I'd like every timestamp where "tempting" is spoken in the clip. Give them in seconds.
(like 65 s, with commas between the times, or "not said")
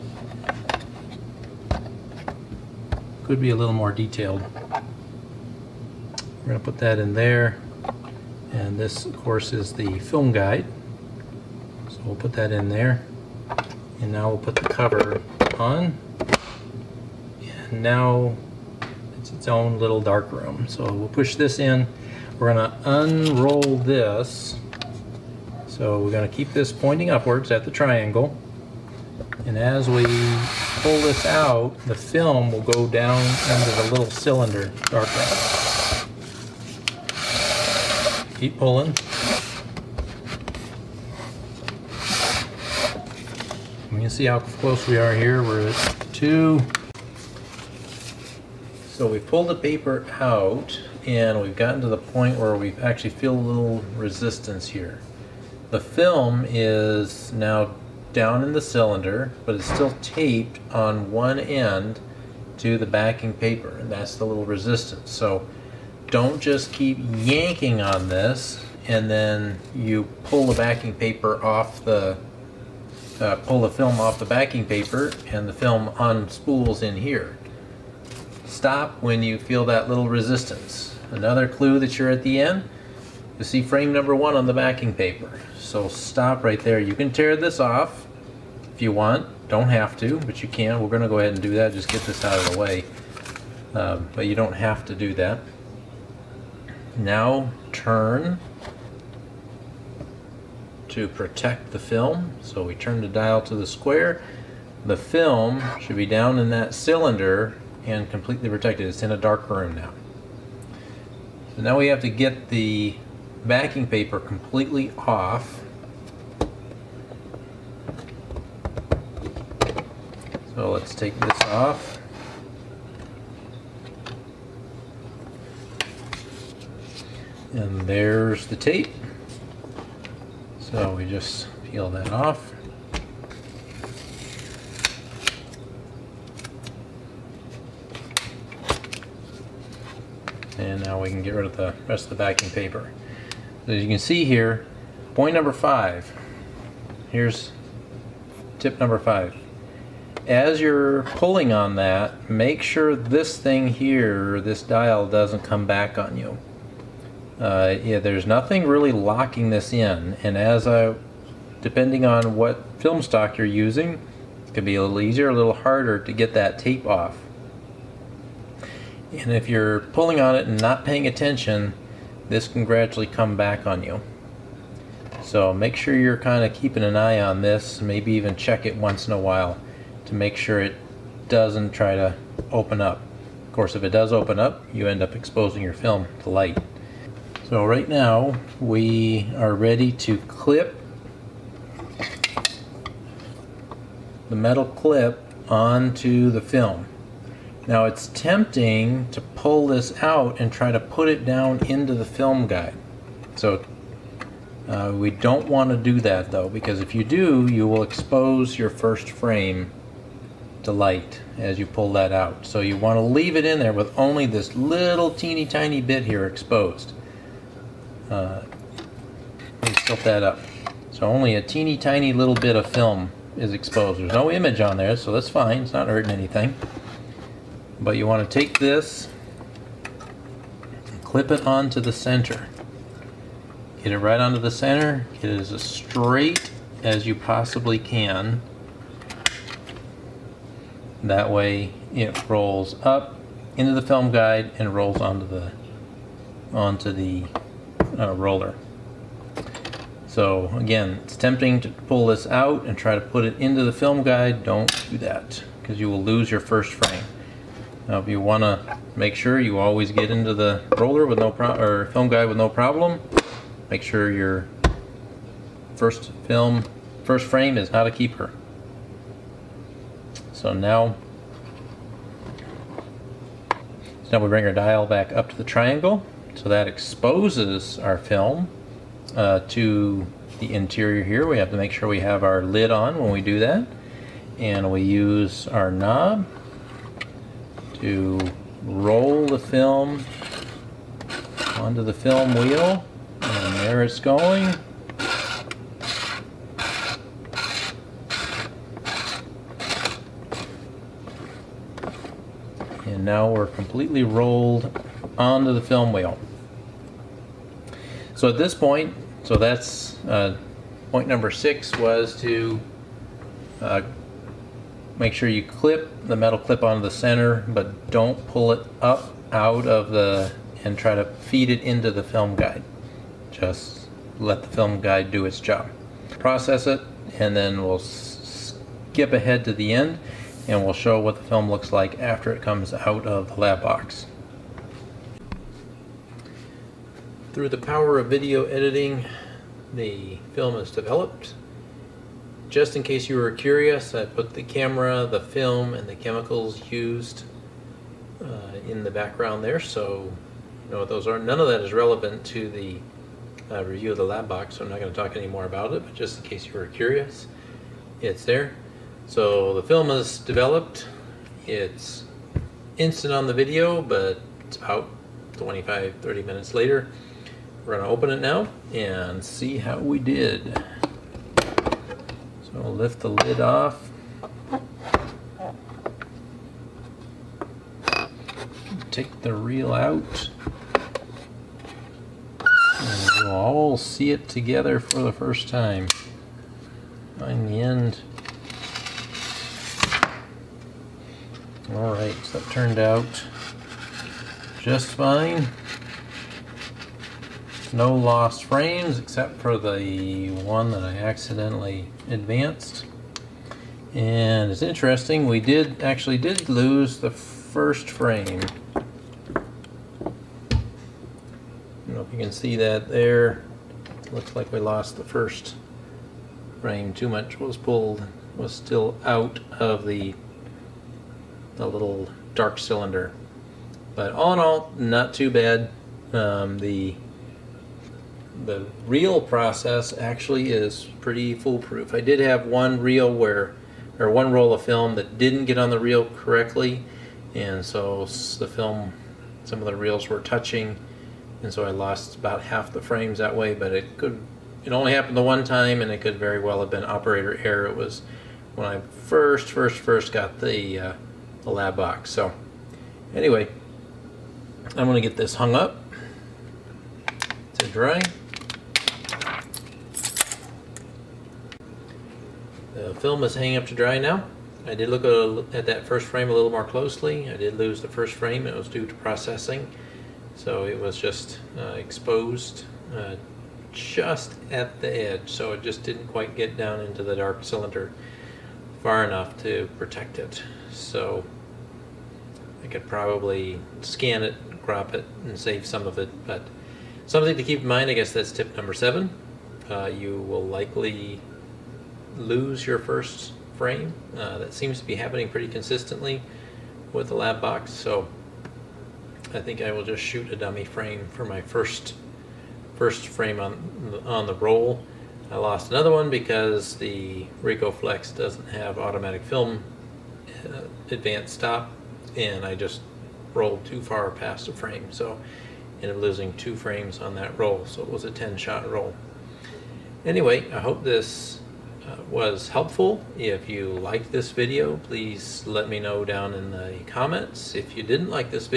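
198 s, 251 s.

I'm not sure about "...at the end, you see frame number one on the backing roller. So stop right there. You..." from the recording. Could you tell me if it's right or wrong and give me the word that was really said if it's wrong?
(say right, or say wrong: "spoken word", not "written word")
wrong: "paper", not "roller".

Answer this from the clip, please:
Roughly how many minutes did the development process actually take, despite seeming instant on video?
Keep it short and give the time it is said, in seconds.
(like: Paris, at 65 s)
25 to 30 minutes, at 365 s.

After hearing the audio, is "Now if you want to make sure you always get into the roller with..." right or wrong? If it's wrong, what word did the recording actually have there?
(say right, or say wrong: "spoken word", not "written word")
right.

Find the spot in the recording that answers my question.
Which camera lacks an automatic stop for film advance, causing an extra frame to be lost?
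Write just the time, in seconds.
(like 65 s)
507 s.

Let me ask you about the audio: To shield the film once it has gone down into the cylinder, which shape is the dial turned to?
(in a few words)
Square.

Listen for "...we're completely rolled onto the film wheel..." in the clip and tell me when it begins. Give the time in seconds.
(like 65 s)
303 s.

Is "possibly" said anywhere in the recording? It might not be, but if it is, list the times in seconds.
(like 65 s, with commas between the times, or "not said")
237 s.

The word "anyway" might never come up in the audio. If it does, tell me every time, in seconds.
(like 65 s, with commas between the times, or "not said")
453 s, 520 s.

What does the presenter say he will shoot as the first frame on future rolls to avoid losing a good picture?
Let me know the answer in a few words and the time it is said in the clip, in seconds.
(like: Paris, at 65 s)
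A dummy frame, at 500 s.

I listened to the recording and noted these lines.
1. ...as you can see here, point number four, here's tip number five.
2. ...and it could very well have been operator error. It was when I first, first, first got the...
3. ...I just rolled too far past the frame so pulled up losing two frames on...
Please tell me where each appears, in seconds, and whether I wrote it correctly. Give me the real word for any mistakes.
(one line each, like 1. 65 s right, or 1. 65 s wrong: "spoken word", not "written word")
1. 143 s wrong: "five", not "four"
2. 445 s right
3. 512 s wrong: "ended", not "pulled".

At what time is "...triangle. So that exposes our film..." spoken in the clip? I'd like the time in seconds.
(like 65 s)
275 s.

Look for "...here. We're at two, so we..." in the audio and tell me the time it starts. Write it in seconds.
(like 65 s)
45 s.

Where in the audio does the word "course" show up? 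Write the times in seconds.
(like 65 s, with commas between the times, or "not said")
9 s, 183 s.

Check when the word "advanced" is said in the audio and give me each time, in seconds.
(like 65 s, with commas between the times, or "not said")
402 s, 510 s.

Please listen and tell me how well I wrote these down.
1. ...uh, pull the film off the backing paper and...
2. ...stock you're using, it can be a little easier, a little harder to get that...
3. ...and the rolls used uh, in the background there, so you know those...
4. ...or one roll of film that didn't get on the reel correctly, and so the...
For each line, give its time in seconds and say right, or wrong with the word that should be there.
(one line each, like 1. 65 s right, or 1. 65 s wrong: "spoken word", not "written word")
1. 73 s right
2. 163 s right
3. 345 s wrong: "chemicals", not "rolls"
4. 433 s right.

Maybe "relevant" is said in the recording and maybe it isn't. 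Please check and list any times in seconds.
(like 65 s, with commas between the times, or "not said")
351 s.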